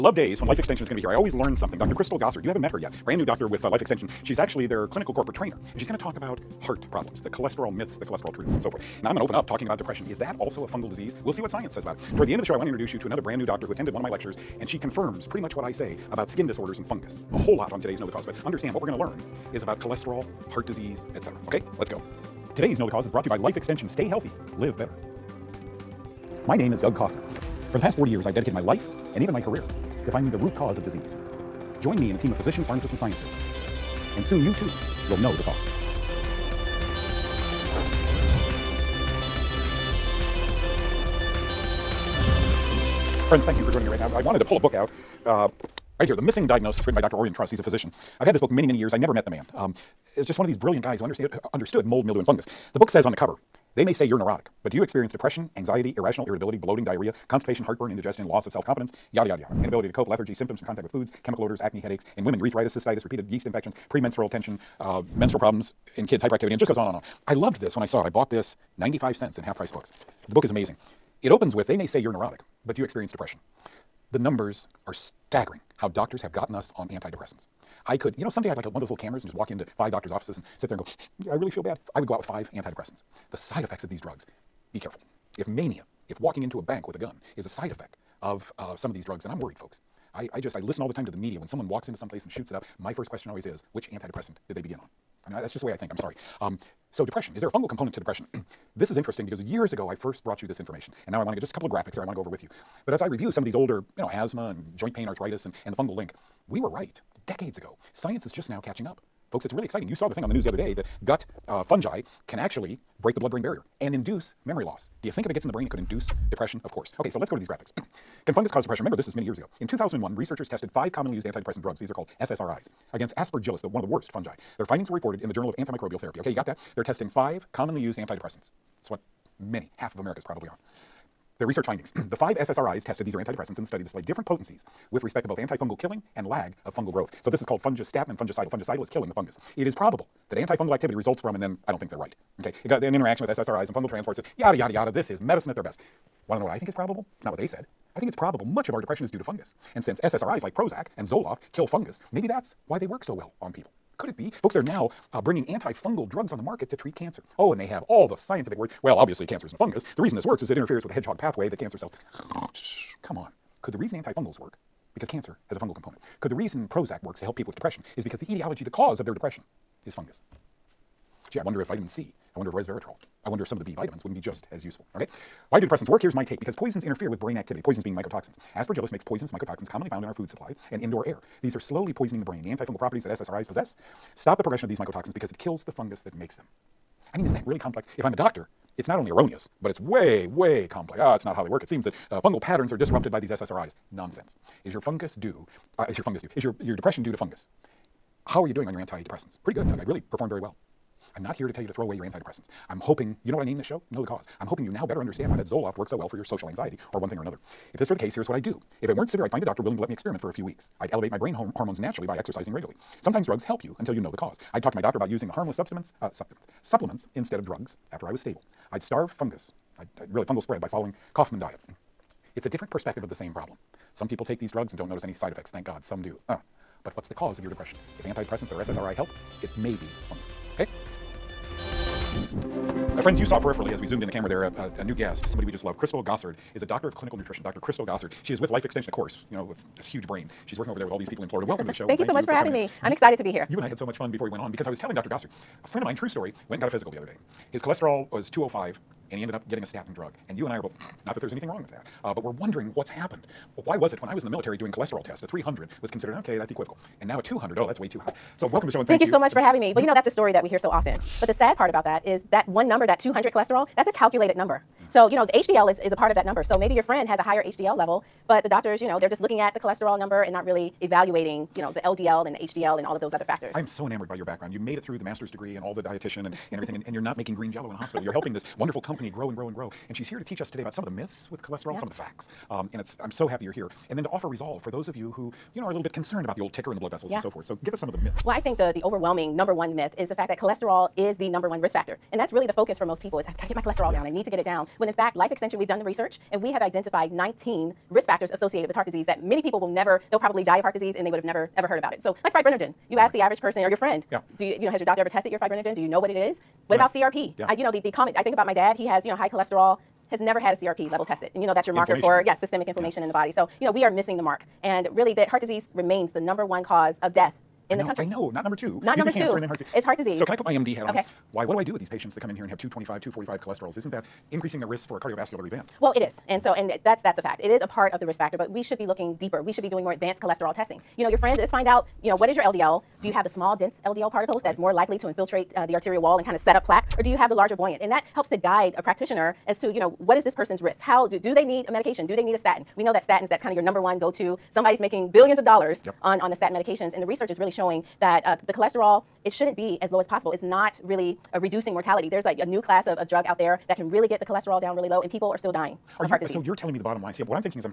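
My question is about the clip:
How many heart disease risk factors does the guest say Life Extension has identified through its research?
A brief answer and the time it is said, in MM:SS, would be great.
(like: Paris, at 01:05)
19, at 04:57.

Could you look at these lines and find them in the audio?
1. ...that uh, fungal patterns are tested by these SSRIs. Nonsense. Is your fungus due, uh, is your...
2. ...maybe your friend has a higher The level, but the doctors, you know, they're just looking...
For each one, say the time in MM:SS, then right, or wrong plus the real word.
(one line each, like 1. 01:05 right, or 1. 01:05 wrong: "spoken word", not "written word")
1. 03:11 wrong: "disrupted", not "tested"
2. 04:26 wrong: "HDL", not "The".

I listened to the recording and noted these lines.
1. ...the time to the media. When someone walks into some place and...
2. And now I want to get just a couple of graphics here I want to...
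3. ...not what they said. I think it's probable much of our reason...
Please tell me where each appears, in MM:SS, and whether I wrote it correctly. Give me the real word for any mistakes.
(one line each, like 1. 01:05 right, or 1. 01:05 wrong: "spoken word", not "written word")
1. 01:30 right
2. 01:41 right
3. 02:27 wrong: "depression", not "reason".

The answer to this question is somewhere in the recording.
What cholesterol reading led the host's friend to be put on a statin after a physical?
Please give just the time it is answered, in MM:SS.
04:08.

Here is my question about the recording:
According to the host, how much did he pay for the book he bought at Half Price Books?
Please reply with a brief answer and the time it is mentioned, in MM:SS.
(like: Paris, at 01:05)
95 cents, at 01:08.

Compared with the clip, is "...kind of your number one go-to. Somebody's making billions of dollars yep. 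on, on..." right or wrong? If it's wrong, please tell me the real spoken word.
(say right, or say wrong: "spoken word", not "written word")
right.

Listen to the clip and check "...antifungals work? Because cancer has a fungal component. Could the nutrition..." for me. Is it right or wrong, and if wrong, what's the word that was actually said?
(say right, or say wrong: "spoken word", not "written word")
wrong: "reason", not "nutrition".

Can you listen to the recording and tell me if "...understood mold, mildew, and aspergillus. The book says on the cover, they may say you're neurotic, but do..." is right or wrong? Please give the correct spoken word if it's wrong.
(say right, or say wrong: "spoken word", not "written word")
wrong: "fungus", not "aspergillus".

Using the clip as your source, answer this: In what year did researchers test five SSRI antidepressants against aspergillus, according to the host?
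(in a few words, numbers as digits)
2001.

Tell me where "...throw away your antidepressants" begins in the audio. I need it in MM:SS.
03:21.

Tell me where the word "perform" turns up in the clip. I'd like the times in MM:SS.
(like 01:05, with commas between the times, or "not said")
03:20.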